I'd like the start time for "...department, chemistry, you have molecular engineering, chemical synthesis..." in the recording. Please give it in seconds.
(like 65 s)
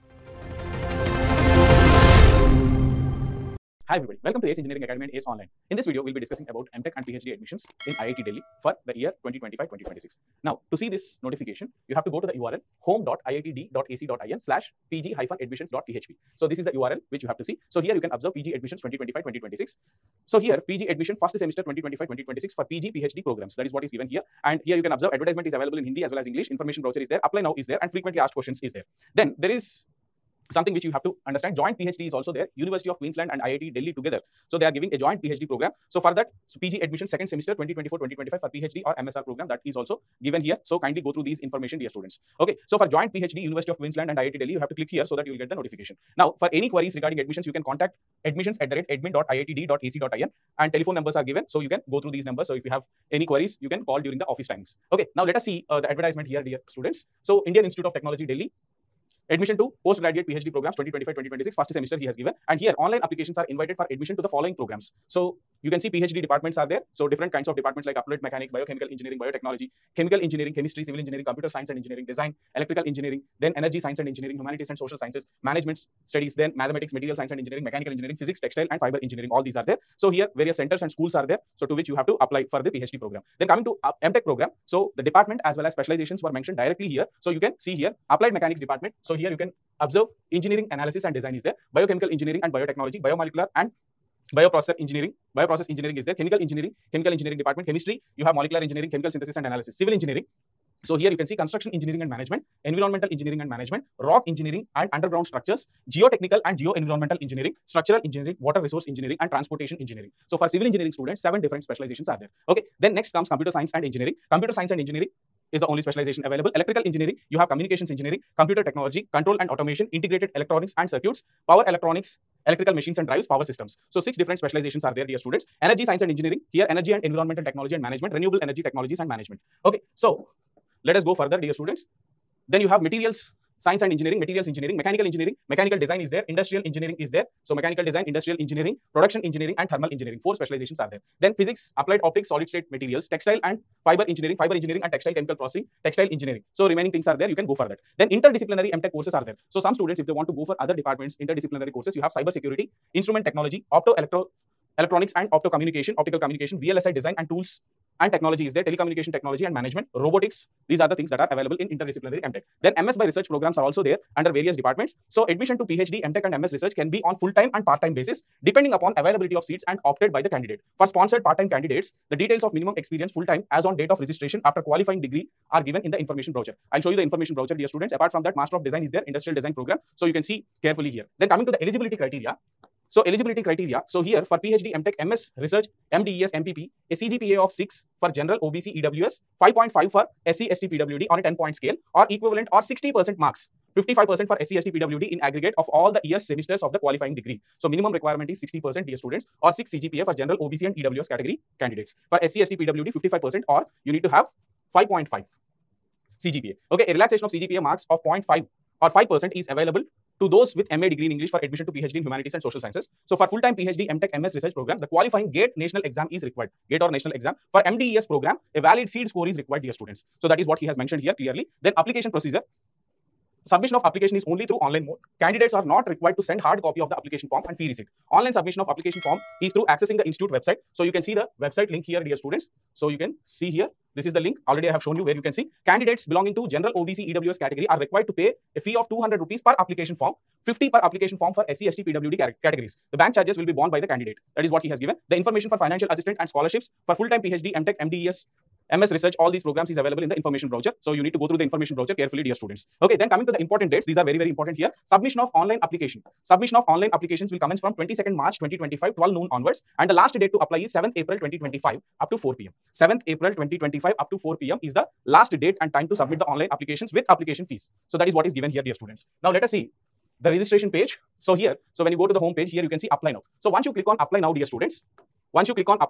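97 s.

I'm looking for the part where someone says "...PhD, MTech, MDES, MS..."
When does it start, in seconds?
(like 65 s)
247 s.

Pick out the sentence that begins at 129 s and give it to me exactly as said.
Okay, so let us go further, dear students.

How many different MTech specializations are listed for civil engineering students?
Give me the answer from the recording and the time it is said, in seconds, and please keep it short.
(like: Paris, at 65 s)
7, at 111 s.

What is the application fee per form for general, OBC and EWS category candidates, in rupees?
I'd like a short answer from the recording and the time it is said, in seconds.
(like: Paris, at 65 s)
200, at 238 s.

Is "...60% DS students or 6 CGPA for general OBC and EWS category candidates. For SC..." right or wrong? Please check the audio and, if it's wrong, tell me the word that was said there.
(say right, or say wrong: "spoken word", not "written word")
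right.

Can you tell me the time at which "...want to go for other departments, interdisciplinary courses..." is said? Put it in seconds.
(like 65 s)
150 s.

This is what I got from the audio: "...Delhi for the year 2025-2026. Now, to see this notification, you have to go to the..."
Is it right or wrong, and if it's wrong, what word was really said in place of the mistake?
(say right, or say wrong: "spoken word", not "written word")
right.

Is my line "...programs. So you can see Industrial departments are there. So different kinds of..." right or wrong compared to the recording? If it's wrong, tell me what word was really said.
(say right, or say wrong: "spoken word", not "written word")
wrong: "PhD", not "Industrial".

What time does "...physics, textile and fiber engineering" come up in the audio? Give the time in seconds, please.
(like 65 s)
78 s.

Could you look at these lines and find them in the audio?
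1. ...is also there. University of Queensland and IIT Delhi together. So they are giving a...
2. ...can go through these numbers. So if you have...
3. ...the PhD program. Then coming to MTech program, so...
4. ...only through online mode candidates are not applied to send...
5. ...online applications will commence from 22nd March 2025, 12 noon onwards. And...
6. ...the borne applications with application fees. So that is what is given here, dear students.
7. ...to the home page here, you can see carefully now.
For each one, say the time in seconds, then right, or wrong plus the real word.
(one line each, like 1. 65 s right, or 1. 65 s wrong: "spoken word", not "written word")
1. 32 s right
2. 51 s right
3. 82 s right
4. 224 s wrong: "required", not "applied"
5. 256 s right
6. 266 s wrong: "online", not "borne"
7. 272 s wrong: "apply", not "carefully".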